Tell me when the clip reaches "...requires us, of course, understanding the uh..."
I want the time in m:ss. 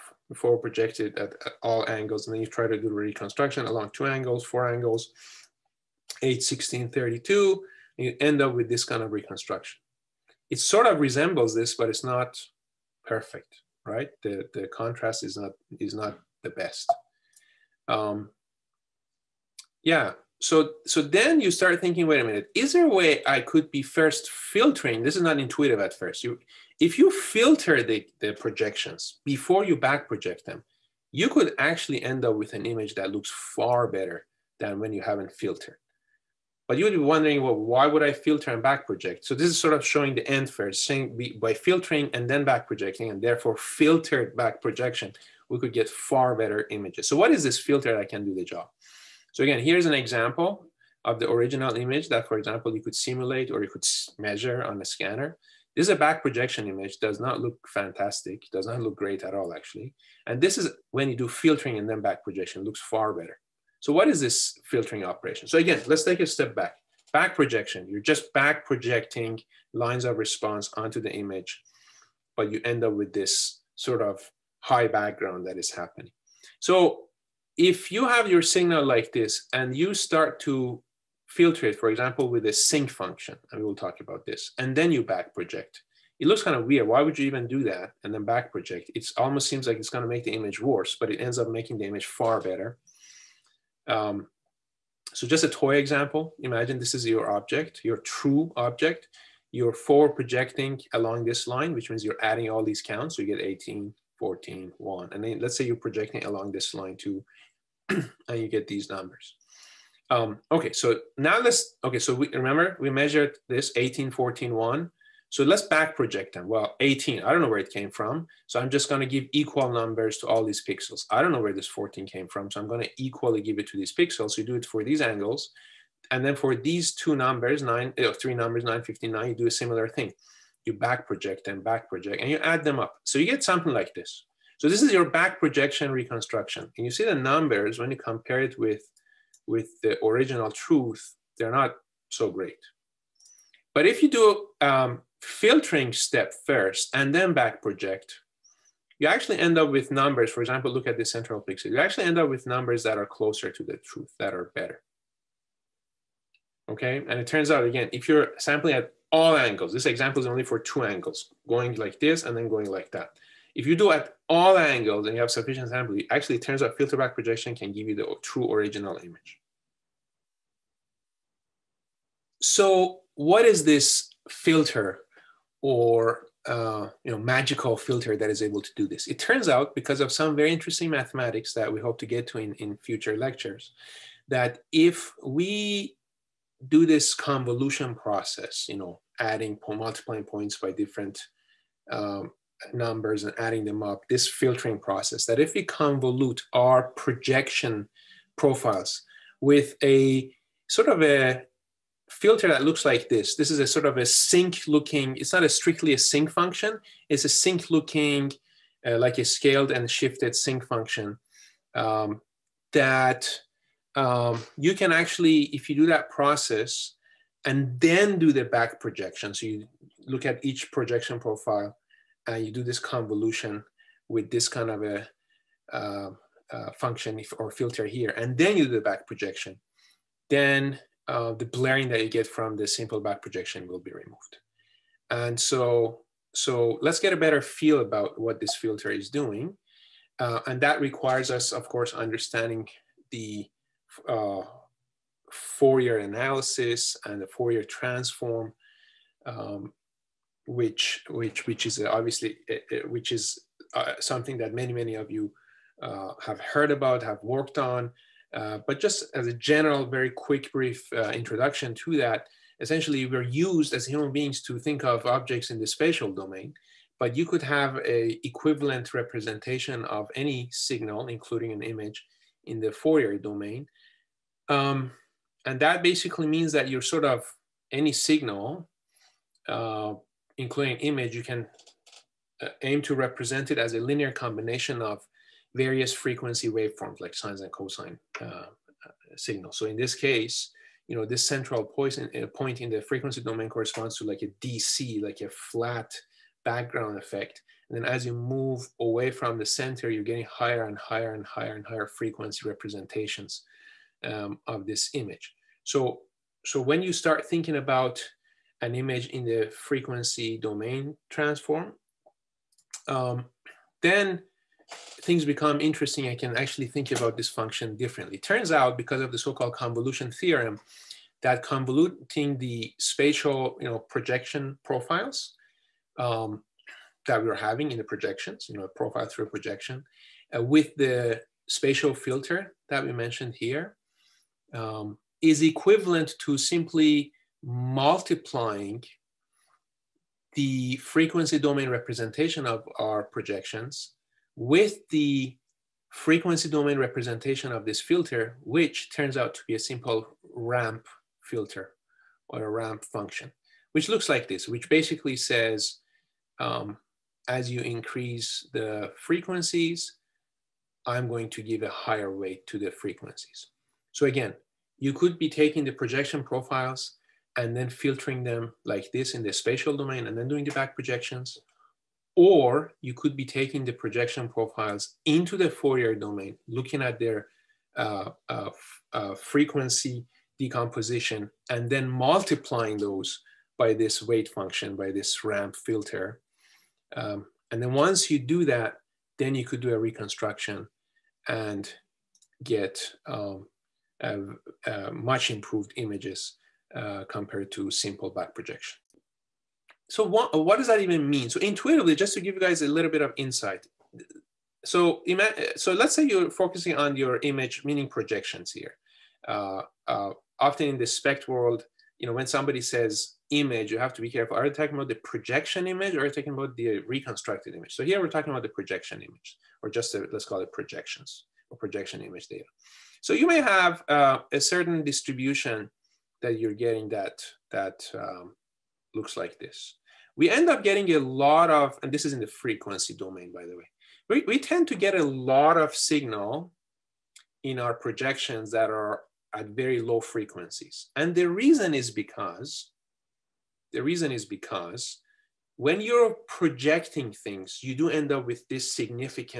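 4:00.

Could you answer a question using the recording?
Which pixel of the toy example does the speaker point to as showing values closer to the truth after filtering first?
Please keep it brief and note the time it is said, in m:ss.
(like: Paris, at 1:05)
The central pixel, at 2:31.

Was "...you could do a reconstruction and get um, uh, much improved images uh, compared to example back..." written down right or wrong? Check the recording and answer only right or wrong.
wrong.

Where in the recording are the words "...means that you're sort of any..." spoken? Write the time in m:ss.
4:36.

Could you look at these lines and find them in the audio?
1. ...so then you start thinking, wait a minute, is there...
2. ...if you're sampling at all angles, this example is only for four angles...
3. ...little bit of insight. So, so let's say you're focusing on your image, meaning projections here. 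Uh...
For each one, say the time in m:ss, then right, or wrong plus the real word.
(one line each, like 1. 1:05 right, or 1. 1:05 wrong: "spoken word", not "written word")
1. 0:20 right
2. 2:37 wrong: "two", not "four"
3. 6:42 right.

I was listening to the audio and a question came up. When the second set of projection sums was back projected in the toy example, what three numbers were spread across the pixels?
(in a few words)
9, 5, 9.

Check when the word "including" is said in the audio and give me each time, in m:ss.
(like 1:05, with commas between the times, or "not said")
4:31, 4:40.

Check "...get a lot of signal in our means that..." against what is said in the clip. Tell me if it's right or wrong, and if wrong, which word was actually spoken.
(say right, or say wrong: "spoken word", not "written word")
wrong: "projections", not "means".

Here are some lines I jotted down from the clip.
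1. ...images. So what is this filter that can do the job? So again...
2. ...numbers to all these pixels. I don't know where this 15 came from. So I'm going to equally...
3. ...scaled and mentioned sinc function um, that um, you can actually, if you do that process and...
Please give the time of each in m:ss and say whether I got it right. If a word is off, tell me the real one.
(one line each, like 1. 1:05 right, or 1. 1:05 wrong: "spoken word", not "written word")
1. 0:46 right
2. 1:59 wrong: "14", not "15"
3. 3:29 wrong: "shifted", not "mentioned".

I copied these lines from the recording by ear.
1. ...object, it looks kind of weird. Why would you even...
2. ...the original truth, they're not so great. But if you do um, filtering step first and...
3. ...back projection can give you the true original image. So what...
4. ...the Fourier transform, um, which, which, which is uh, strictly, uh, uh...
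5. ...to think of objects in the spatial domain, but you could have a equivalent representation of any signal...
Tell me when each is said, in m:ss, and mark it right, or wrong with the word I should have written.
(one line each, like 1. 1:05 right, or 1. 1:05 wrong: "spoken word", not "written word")
1. 1:25 wrong: "project", not "object"
2. 2:19 right
3. 2:46 right
4. 4:07 wrong: "obviously", not "strictly"
5. 4:24 right.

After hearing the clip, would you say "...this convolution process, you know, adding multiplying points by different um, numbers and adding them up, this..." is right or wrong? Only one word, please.
right.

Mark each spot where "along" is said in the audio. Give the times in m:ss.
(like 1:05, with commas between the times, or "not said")
0:03, 1:40, 1:46.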